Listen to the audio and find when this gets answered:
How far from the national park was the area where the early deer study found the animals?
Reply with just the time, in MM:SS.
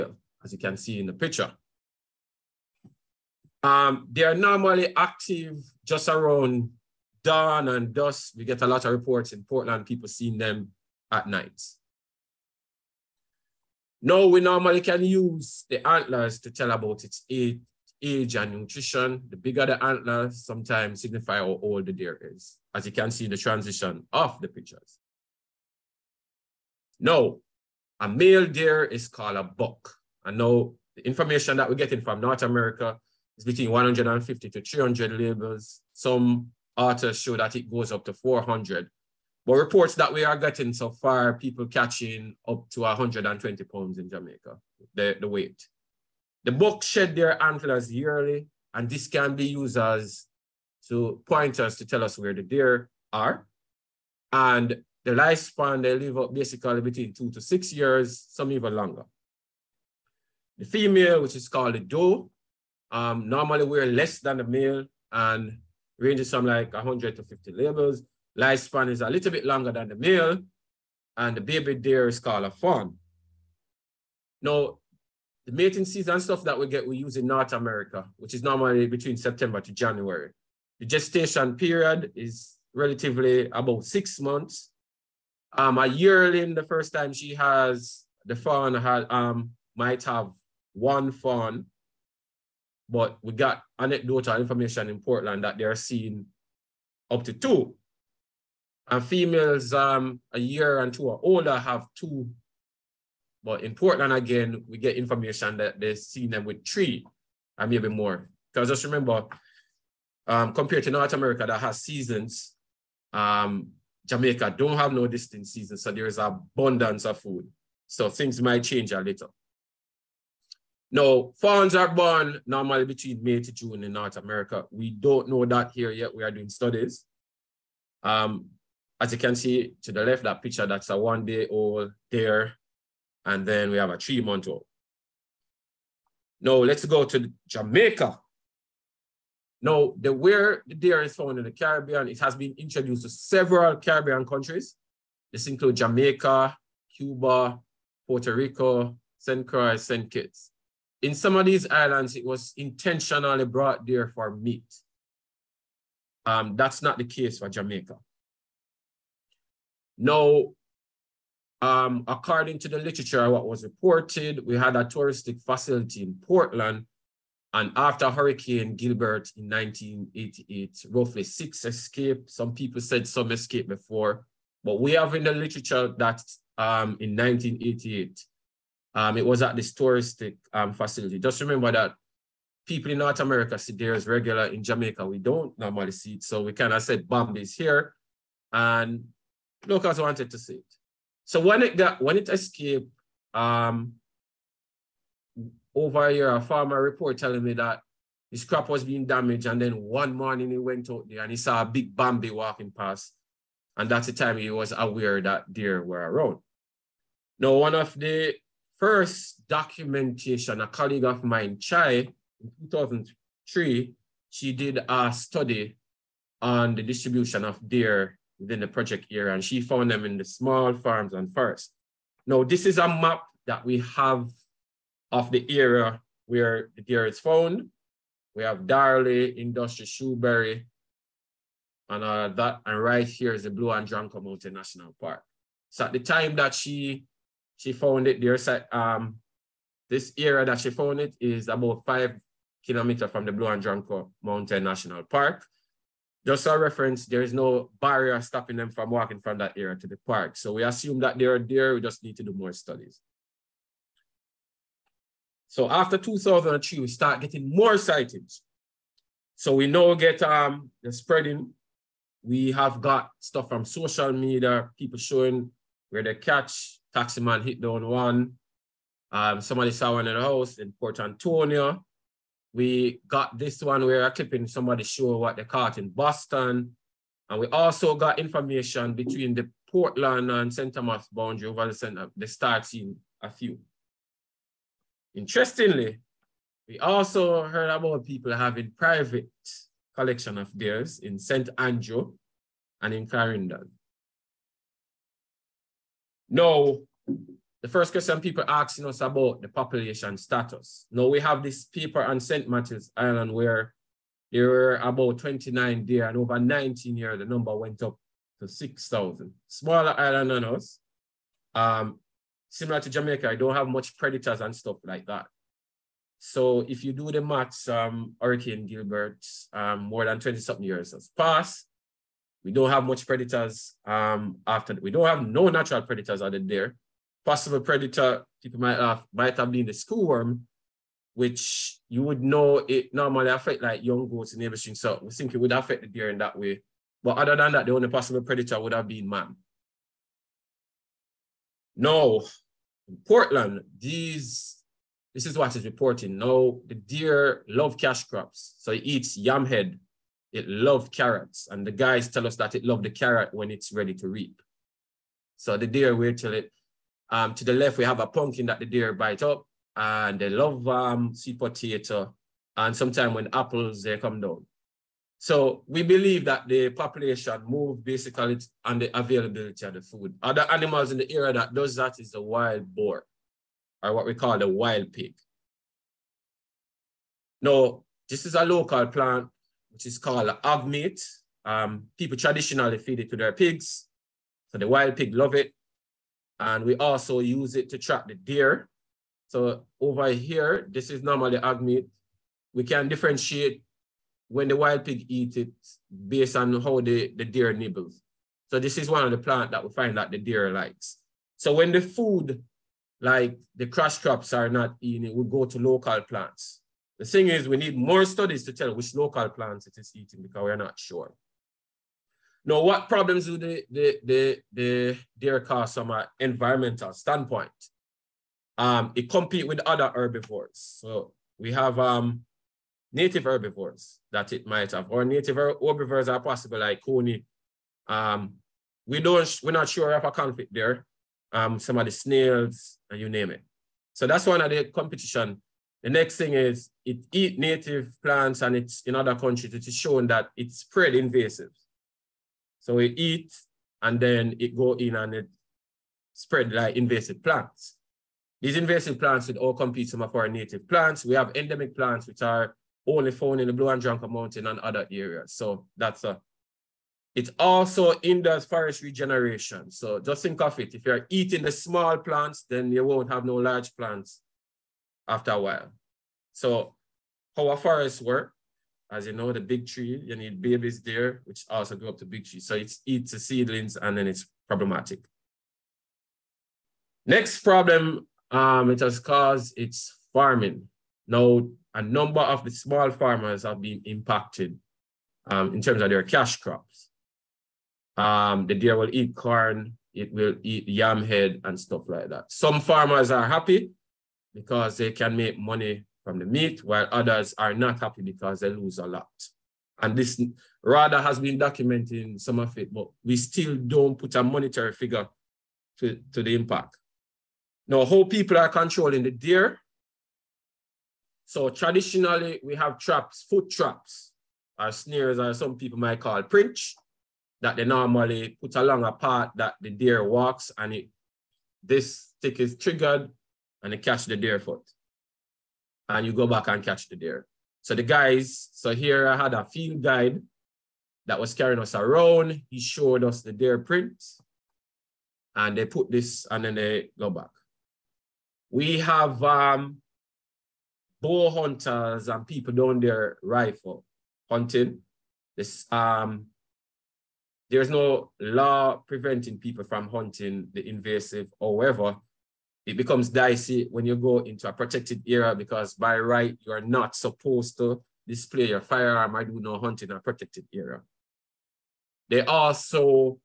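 04:01.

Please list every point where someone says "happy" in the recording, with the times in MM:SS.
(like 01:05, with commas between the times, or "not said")
08:13, 08:17.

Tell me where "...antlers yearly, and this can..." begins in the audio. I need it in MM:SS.
00:47.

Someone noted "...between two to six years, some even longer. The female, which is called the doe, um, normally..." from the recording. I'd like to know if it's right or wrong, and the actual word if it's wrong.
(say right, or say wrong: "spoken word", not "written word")
right.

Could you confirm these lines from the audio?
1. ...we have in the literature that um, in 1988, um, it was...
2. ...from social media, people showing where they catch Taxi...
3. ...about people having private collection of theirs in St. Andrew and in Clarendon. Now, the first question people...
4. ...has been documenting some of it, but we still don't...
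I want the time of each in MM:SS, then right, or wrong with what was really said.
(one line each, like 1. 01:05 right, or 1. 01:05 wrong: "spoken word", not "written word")
1. 02:54 right
2. 04:23 right
3. 04:47 right
4. 08:21 right.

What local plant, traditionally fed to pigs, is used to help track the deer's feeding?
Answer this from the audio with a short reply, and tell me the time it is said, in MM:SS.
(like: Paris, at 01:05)
Agmeat, at 06:20.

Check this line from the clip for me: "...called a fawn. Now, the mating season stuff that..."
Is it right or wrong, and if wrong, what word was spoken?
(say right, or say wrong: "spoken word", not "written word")
right.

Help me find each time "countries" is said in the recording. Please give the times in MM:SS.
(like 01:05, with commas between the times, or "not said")
02:24, 07:19.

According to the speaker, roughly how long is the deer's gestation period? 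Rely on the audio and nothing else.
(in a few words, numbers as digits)
About six months.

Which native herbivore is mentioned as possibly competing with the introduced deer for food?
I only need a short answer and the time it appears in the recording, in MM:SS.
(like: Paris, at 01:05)
Coney, at 07:06.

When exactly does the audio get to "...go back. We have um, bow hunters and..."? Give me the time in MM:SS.
08:56.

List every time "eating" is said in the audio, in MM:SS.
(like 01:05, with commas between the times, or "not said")
06:44, 06:49, 07:41.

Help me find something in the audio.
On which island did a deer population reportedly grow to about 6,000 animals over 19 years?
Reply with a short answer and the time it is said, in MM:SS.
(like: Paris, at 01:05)
St. Martin's Island, at 05:02.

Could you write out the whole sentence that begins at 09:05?
This um, there's no law preventing people from hunting the invasive.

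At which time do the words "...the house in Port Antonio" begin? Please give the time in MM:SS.
04:30.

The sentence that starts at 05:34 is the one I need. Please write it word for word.
So we think it would affect the deer in that way.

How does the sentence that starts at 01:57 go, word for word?
So things might change a little.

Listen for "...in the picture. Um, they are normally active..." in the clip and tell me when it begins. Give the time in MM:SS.
00:01.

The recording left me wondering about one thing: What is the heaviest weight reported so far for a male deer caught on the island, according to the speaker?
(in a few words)
120 pounds.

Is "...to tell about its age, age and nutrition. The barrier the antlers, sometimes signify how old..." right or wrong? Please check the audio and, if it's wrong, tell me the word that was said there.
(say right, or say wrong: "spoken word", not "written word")
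wrong: "bigger", not "barrier".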